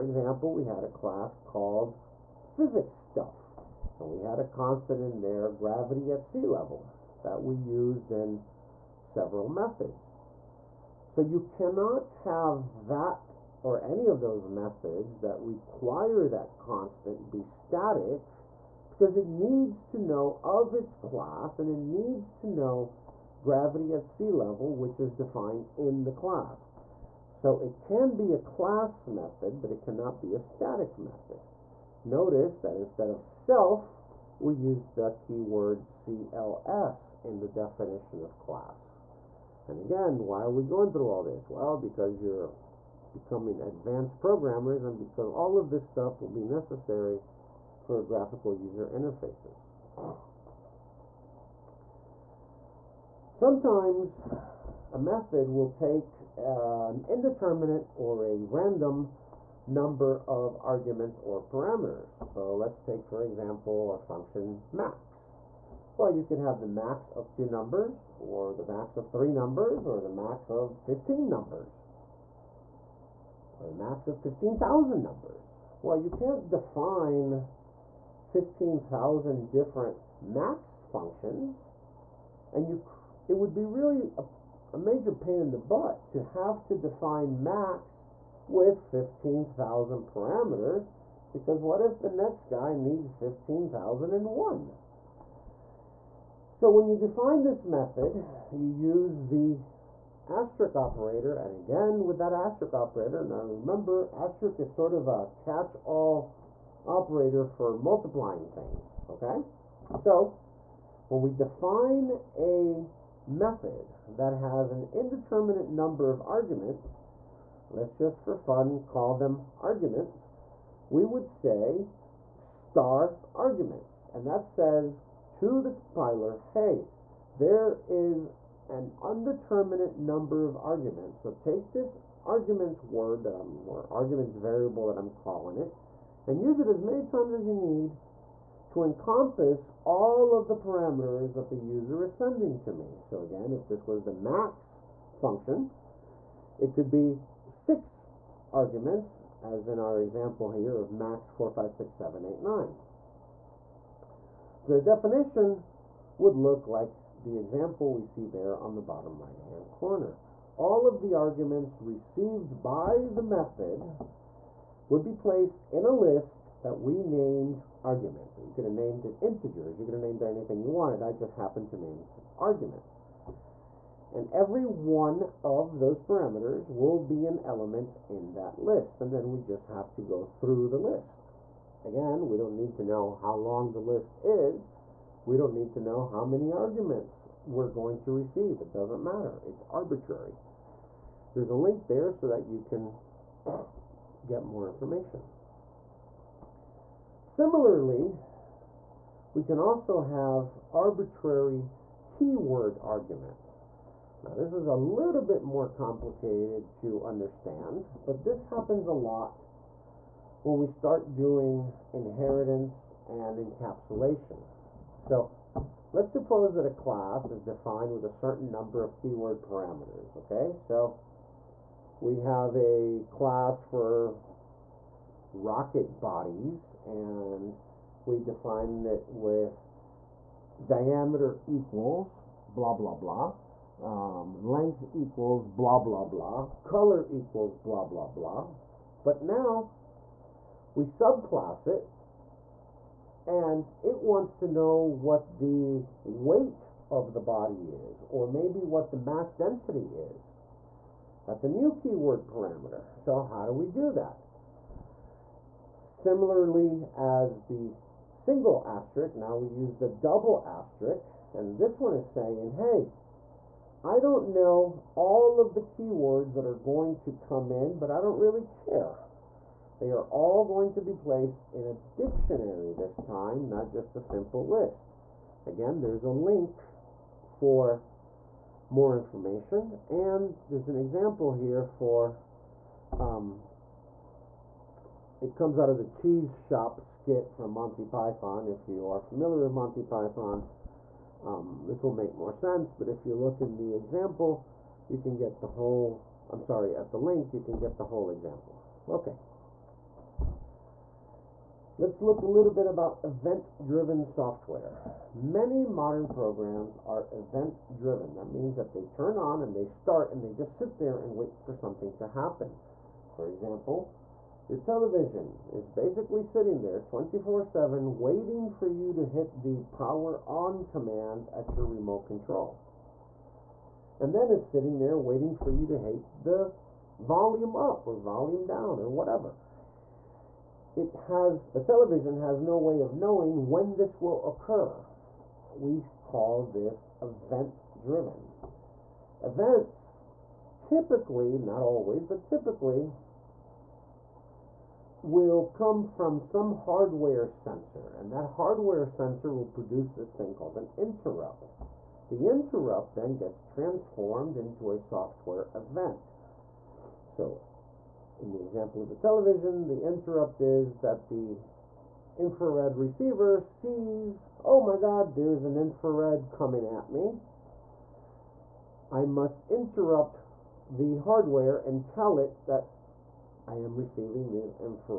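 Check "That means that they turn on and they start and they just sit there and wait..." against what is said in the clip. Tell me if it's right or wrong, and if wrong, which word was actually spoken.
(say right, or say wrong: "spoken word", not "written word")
right.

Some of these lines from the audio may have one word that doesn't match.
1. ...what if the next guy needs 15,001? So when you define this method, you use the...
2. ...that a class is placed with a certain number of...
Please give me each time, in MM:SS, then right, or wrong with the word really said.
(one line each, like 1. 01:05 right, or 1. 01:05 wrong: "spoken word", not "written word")
1. 01:31 right
2. 03:36 wrong: "defined", not "placed".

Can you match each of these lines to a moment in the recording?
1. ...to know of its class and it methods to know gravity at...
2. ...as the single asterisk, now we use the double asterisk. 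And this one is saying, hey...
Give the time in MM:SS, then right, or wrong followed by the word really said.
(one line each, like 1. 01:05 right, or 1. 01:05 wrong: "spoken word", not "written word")
1. 00:19 wrong: "needs", not "methods"
2. 04:16 right.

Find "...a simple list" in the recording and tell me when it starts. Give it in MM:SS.
04:33.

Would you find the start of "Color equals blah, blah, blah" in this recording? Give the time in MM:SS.
03:56.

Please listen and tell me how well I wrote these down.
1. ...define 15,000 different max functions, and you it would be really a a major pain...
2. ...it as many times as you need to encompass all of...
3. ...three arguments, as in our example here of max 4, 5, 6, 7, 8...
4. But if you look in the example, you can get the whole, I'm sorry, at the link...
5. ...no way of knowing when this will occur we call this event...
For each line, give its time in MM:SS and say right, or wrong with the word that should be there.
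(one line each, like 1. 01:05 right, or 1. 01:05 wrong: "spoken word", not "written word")
1. 01:16 right
2. 02:16 right
3. 02:27 wrong: "six", not "three"
4. 04:52 right
5. 05:32 right.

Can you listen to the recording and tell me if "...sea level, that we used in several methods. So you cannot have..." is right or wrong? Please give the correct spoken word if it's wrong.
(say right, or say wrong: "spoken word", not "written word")
right.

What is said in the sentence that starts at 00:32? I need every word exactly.
Notice that instead of self, we use the keyword CLS in the definition of class.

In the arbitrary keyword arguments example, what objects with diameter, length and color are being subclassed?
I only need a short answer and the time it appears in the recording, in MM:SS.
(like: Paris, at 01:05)
rocket bodies, at 03:45.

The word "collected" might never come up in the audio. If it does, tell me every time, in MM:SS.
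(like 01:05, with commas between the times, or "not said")
not said.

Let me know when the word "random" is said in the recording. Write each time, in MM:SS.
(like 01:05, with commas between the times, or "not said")
00:58.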